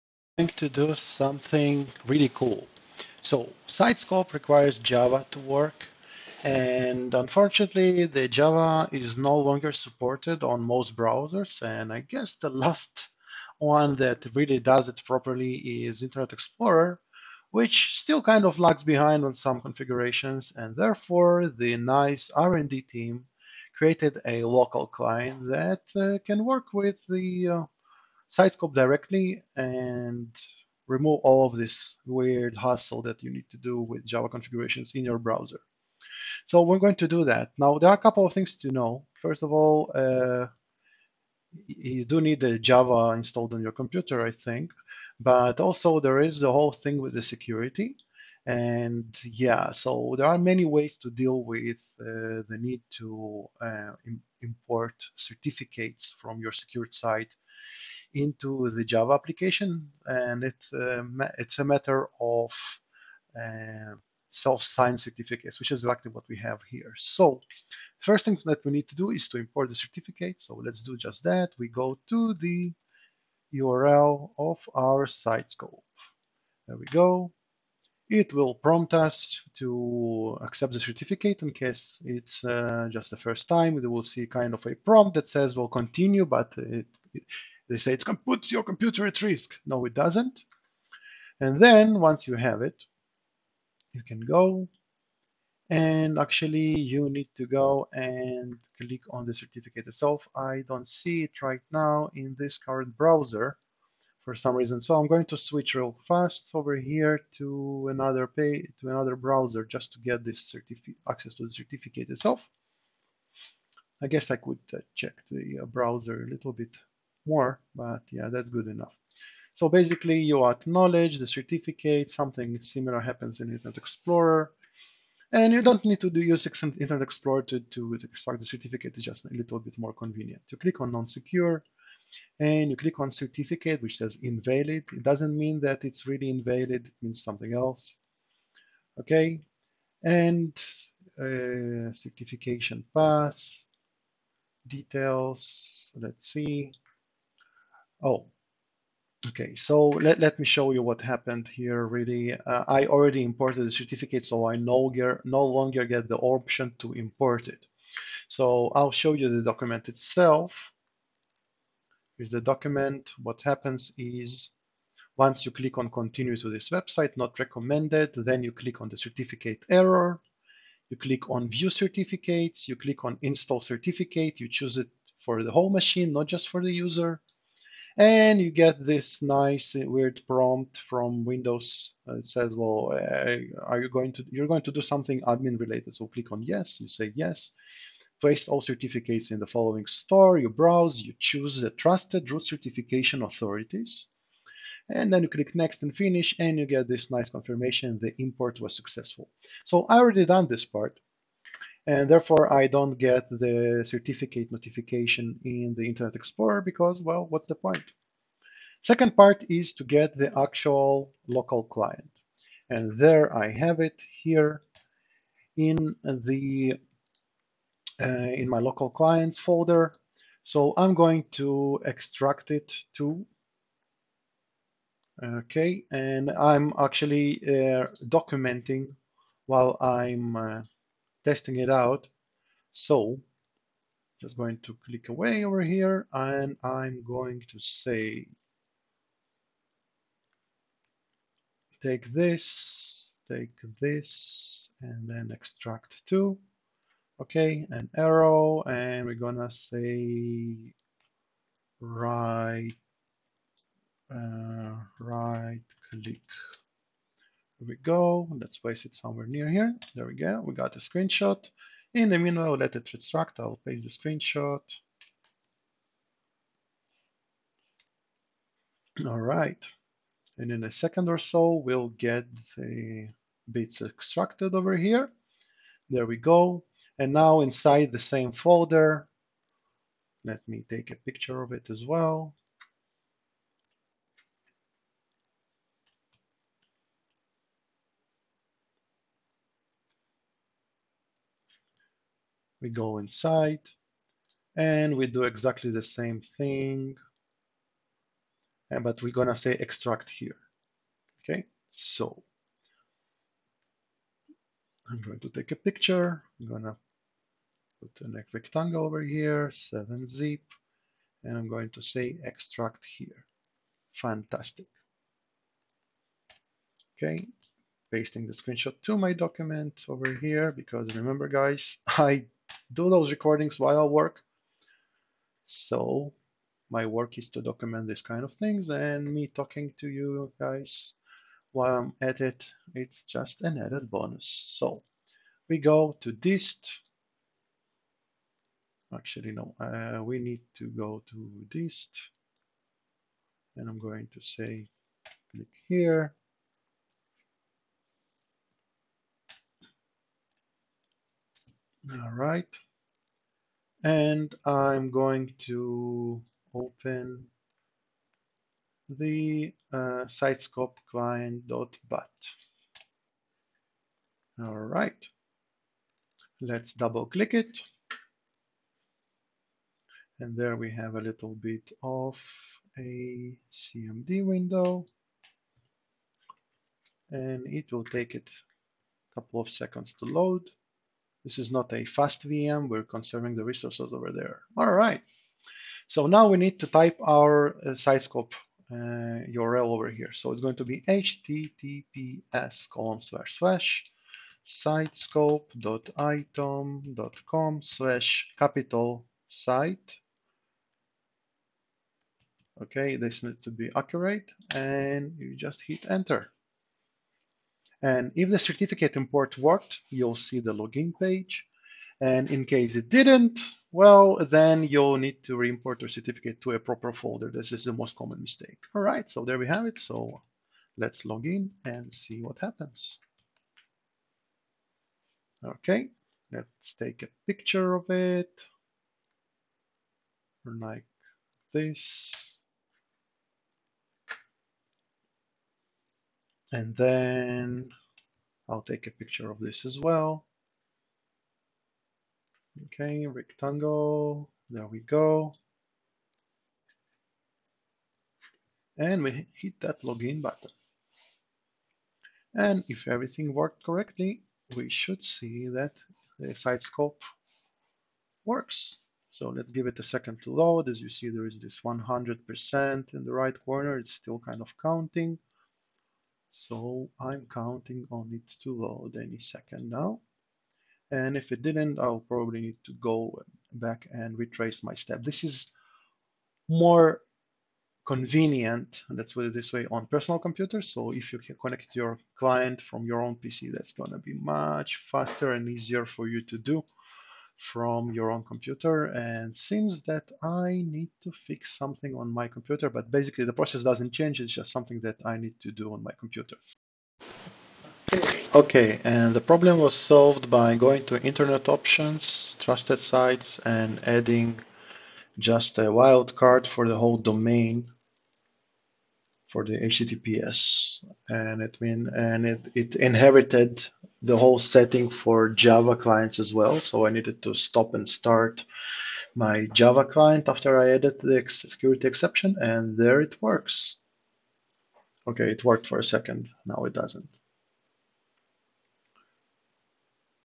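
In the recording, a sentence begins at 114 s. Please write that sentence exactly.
I guess I could uh, check the uh, browser a little bit more, but yeah, that's good enough.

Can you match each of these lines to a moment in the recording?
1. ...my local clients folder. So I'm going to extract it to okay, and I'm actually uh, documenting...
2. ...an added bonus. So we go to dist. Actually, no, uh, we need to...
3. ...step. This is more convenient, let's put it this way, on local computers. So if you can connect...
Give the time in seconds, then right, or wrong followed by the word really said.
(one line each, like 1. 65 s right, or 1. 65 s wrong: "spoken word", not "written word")
1. 218 s right
2. 333 s right
3. 474 s wrong: "personal", not "local".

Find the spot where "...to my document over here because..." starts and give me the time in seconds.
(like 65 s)
318 s.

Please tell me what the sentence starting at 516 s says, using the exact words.
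So I needed to stop and start my Java client after I added the security exception and there it works.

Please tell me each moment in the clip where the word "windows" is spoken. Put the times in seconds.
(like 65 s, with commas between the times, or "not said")
181 s, 374 s.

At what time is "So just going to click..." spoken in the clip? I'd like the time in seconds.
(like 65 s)
232 s.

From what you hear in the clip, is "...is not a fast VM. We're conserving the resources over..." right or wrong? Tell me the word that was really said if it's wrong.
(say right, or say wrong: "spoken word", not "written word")
right.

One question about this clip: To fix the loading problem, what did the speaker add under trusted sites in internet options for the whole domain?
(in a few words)
a wildcard.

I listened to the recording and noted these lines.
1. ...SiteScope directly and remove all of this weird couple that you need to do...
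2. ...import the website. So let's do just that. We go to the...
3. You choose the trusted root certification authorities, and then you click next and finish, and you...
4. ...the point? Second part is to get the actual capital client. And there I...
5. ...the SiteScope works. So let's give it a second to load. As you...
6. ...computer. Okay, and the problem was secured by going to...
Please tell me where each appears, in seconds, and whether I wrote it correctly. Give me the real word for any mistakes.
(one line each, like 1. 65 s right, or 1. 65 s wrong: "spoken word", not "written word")
1. 28 s wrong: "hassle", not "couple"
2. 69 s wrong: "certificate", not "website"
3. 191 s right
4. 207 s wrong: "local", not "capital"
5. 456 s right
6. 495 s wrong: "solved", not "secured".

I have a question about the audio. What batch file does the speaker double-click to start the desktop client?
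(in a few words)
sitescope client.bat.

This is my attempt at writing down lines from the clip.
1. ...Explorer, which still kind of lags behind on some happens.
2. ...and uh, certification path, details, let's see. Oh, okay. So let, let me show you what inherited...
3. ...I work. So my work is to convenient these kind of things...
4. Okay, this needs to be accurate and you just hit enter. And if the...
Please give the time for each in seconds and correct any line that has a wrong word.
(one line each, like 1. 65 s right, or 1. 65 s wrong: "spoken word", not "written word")
1. 16 s wrong: "configurations", not "happens"
2. 140 s wrong: "happened", not "inherited"
3. 323 s wrong: "document", not "convenient"
4. 402 s right.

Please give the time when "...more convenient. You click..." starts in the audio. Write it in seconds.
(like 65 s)
129 s.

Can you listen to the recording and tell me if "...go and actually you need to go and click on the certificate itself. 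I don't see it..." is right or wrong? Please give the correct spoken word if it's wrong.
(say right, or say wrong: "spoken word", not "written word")
right.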